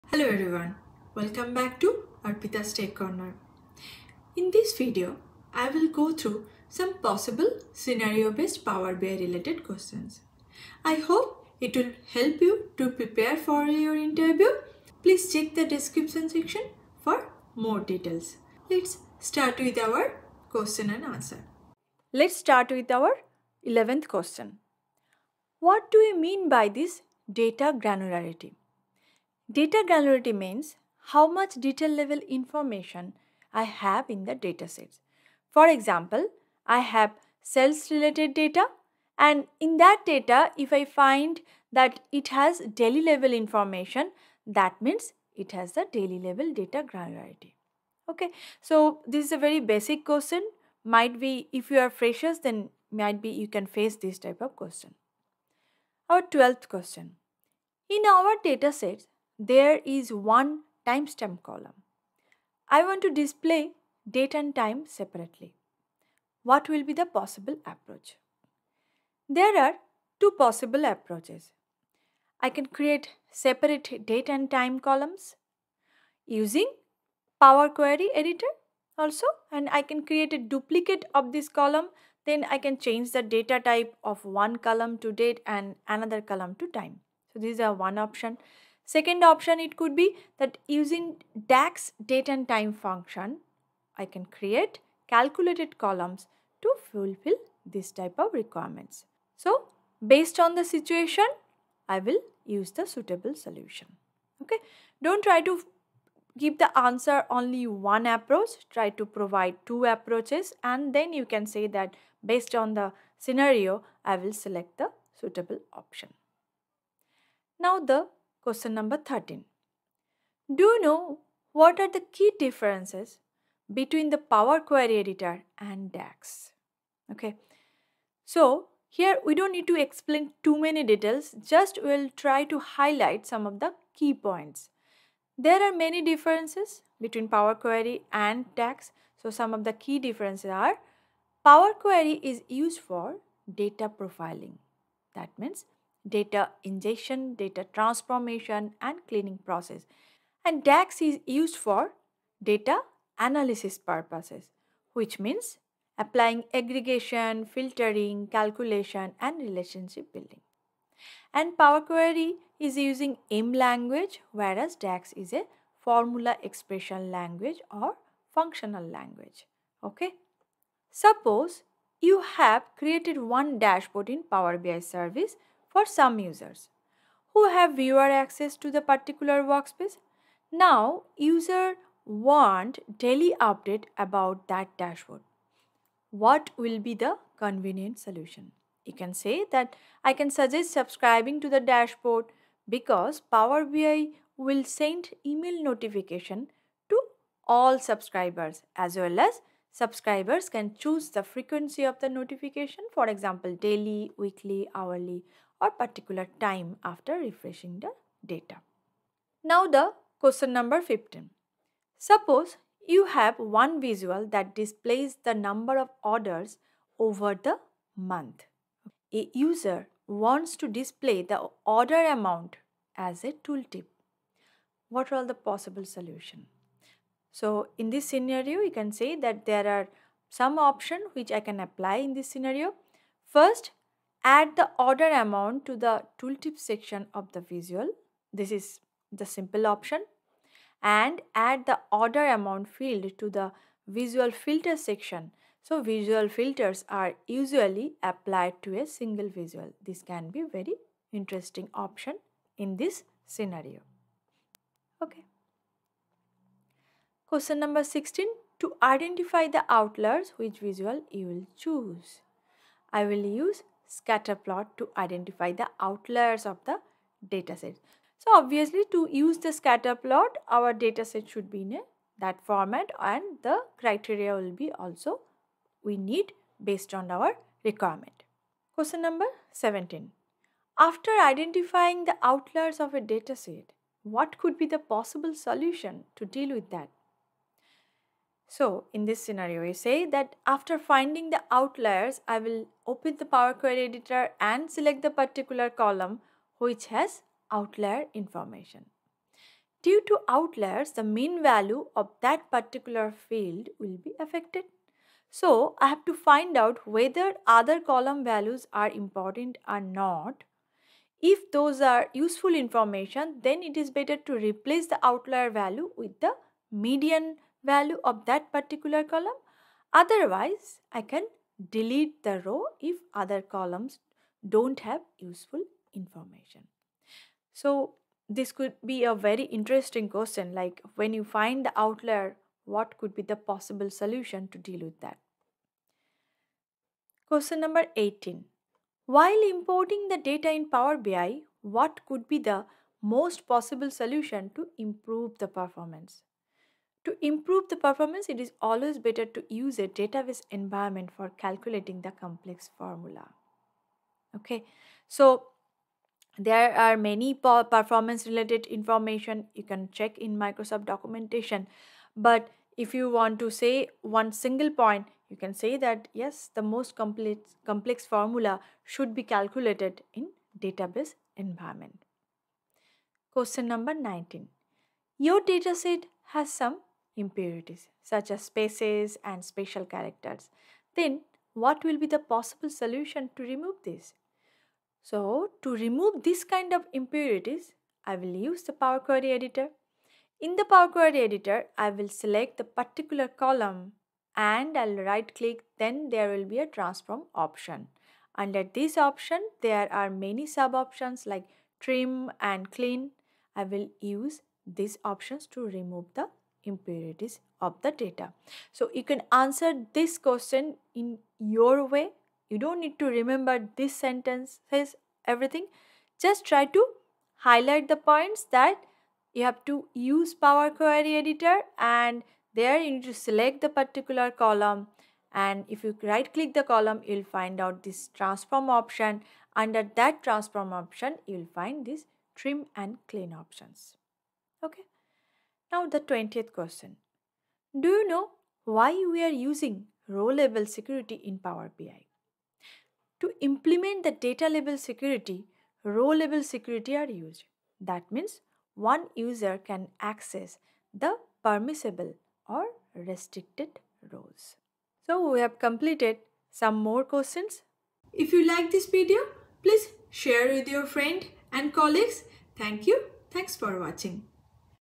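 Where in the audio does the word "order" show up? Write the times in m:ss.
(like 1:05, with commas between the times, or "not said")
3:36, 3:41, 3:54, 4:01.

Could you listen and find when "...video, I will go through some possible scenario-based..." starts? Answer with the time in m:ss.
0:04.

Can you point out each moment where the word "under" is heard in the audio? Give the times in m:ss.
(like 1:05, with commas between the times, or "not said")
6:38, 7:09.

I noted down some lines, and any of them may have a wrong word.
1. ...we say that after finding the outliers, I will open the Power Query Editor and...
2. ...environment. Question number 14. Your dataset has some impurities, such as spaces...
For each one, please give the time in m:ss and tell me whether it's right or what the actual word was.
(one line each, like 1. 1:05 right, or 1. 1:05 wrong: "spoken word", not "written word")
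1. 4:49 right
2. 6:11 wrong: "19", not "14".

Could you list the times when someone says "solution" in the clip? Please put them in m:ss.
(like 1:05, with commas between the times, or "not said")
1:43, 3:07, 3:45, 4:45, 5:33, 5:43, 6:22.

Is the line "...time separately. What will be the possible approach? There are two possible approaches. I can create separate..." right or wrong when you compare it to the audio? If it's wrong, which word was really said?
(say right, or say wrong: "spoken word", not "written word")
right.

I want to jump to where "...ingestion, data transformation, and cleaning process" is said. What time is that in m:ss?
2:26.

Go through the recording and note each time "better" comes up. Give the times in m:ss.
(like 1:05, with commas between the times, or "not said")
5:13, 5:48.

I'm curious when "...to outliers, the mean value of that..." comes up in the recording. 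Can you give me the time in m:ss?
5:00.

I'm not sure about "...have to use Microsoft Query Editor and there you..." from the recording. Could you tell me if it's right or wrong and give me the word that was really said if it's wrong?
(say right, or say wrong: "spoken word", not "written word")
wrong: "Power", not "Microsoft".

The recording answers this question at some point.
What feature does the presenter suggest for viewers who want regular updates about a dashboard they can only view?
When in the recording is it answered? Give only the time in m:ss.
3:10.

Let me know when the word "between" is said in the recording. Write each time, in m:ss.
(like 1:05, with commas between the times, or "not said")
2:03, 2:16.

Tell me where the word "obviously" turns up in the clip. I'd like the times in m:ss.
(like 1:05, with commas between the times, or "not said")
4:28.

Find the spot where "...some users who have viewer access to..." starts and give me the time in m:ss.
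2:55.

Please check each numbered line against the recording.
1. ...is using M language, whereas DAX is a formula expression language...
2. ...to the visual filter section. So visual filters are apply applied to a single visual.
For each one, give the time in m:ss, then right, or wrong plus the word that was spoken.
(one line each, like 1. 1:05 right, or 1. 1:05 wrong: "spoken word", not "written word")
1. 2:42 right
2. 4:03 wrong: "usually", not "apply".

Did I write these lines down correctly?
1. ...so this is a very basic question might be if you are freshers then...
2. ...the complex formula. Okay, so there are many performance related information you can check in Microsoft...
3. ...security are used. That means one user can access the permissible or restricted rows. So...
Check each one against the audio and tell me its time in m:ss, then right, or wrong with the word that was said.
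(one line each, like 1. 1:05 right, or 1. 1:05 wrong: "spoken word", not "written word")
1. 0:48 right
2. 5:52 right
3. 7:26 right.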